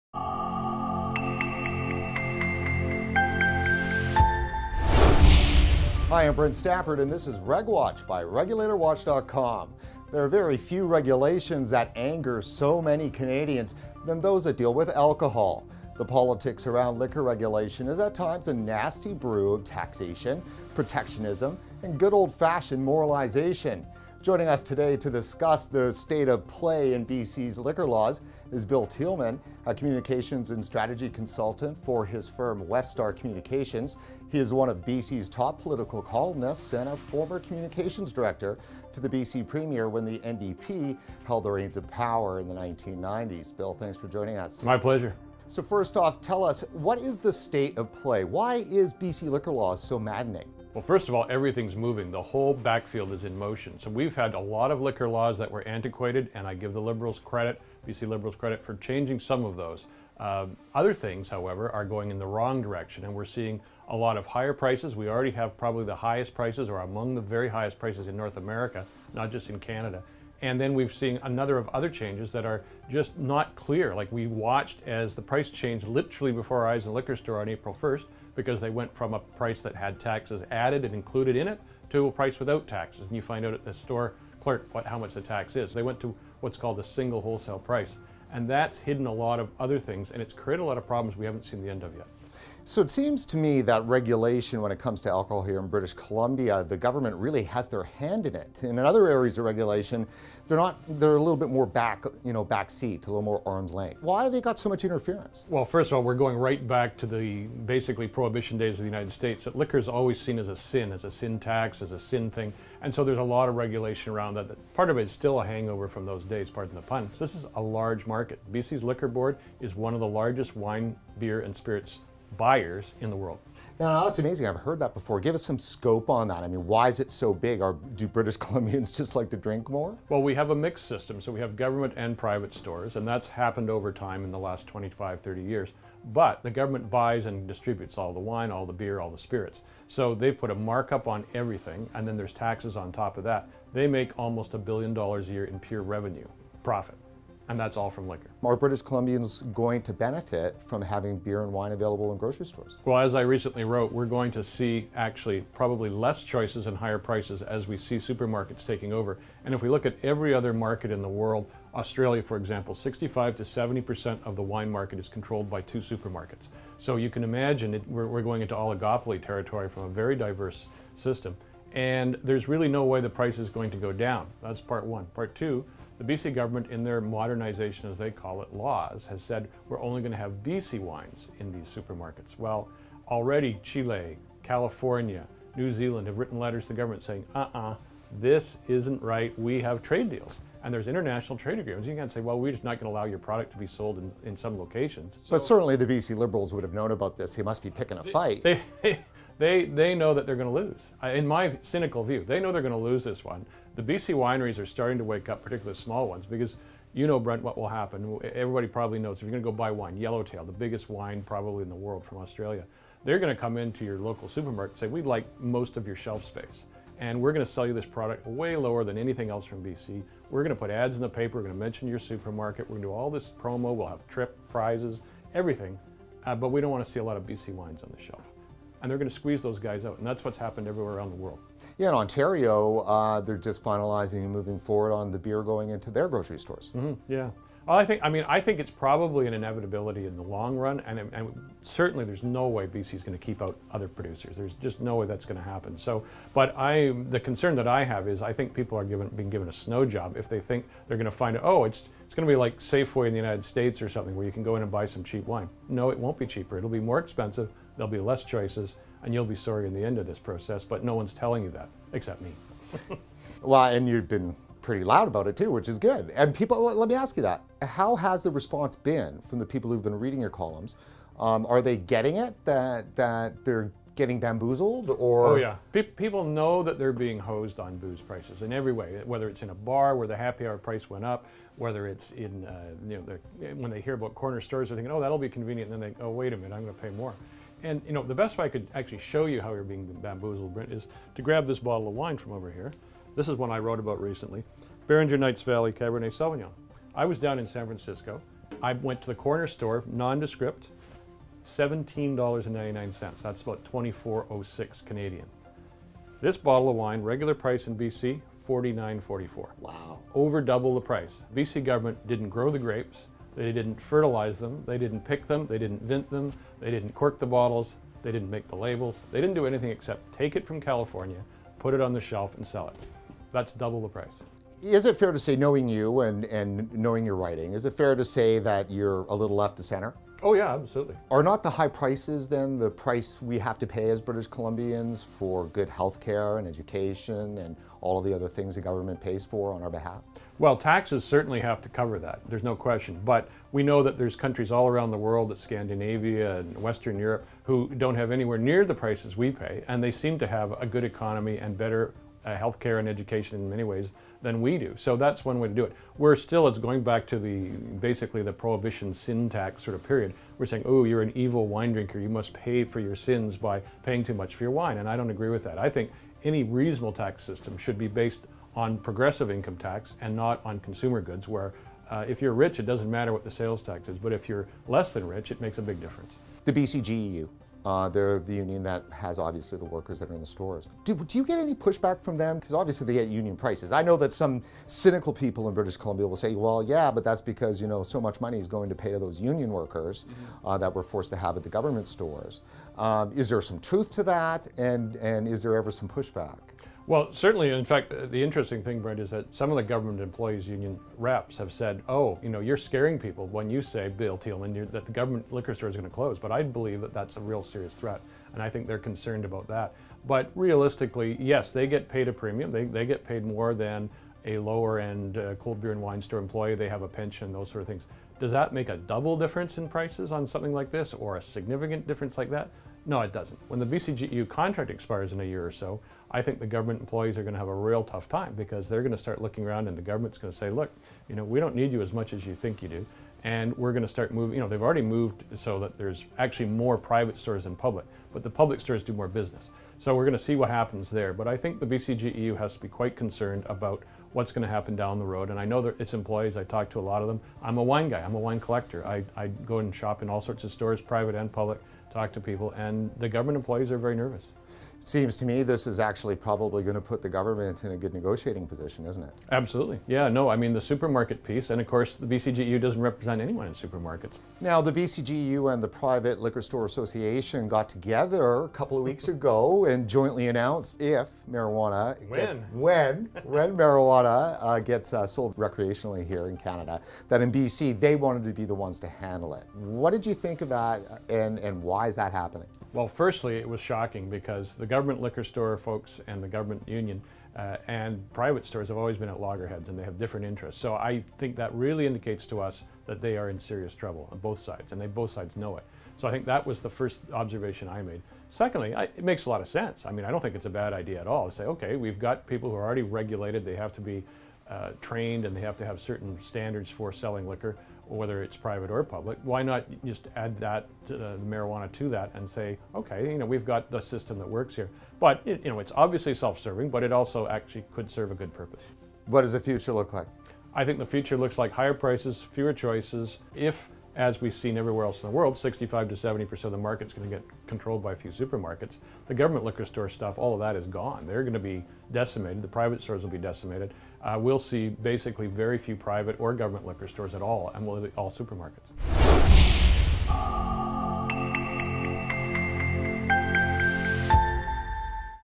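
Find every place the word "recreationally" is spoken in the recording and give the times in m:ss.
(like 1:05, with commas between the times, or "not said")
7:55.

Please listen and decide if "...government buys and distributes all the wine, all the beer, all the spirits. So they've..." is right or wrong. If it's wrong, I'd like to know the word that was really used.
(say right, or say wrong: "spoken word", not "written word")
right.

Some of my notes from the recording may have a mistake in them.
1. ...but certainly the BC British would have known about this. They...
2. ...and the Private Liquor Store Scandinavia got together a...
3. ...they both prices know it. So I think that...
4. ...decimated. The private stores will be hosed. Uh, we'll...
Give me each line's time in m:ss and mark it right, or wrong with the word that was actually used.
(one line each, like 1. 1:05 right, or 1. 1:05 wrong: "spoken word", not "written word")
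1. 3:15 wrong: "Liberals", not "British"
2. 7:45 wrong: "Association", not "Scandinavia"
3. 8:14 wrong: "sides", not "prices"
4. 8:51 wrong: "decimated", not "hosed".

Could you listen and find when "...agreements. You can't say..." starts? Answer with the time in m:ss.
3:11.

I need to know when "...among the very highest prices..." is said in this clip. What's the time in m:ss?
1:06.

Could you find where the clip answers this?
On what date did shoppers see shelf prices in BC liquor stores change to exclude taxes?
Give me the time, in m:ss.
1:17.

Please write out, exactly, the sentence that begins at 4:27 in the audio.
How has the response been from the people who've been reading your columns?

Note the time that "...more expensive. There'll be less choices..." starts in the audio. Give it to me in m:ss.
4:16.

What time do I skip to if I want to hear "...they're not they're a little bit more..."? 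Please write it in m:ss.
1:40.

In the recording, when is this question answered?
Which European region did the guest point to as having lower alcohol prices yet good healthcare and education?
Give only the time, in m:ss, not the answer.
5:45.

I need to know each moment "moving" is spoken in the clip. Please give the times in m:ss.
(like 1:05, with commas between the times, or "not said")
0:51, 3:54, 7:14.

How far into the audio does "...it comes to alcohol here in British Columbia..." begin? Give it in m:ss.
1:34.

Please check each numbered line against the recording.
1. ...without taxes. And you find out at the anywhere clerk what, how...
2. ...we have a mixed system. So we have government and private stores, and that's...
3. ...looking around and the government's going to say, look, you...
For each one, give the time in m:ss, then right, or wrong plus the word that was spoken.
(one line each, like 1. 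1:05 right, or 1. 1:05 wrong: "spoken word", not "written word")
1. 1:22 wrong: "store", not "anywhere"
2. 2:10 right
3. 7:09 right.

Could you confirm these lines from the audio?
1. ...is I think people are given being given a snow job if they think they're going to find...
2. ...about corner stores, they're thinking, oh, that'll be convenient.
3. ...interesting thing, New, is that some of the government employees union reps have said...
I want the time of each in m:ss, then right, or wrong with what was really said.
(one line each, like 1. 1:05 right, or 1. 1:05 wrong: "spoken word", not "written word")
1. 4:08 right
2. 4:43 right
3. 6:38 wrong: "Brent", not "New".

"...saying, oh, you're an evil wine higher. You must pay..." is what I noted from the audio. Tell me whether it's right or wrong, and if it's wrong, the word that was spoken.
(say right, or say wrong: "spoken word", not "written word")
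wrong: "drinker", not "higher".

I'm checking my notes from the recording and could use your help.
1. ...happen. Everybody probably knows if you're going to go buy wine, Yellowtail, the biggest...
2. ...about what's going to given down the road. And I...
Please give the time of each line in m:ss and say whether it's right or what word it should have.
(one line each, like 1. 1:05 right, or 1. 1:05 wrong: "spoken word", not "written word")
1. 3:27 right
2. 7:23 wrong: "happen", not "given".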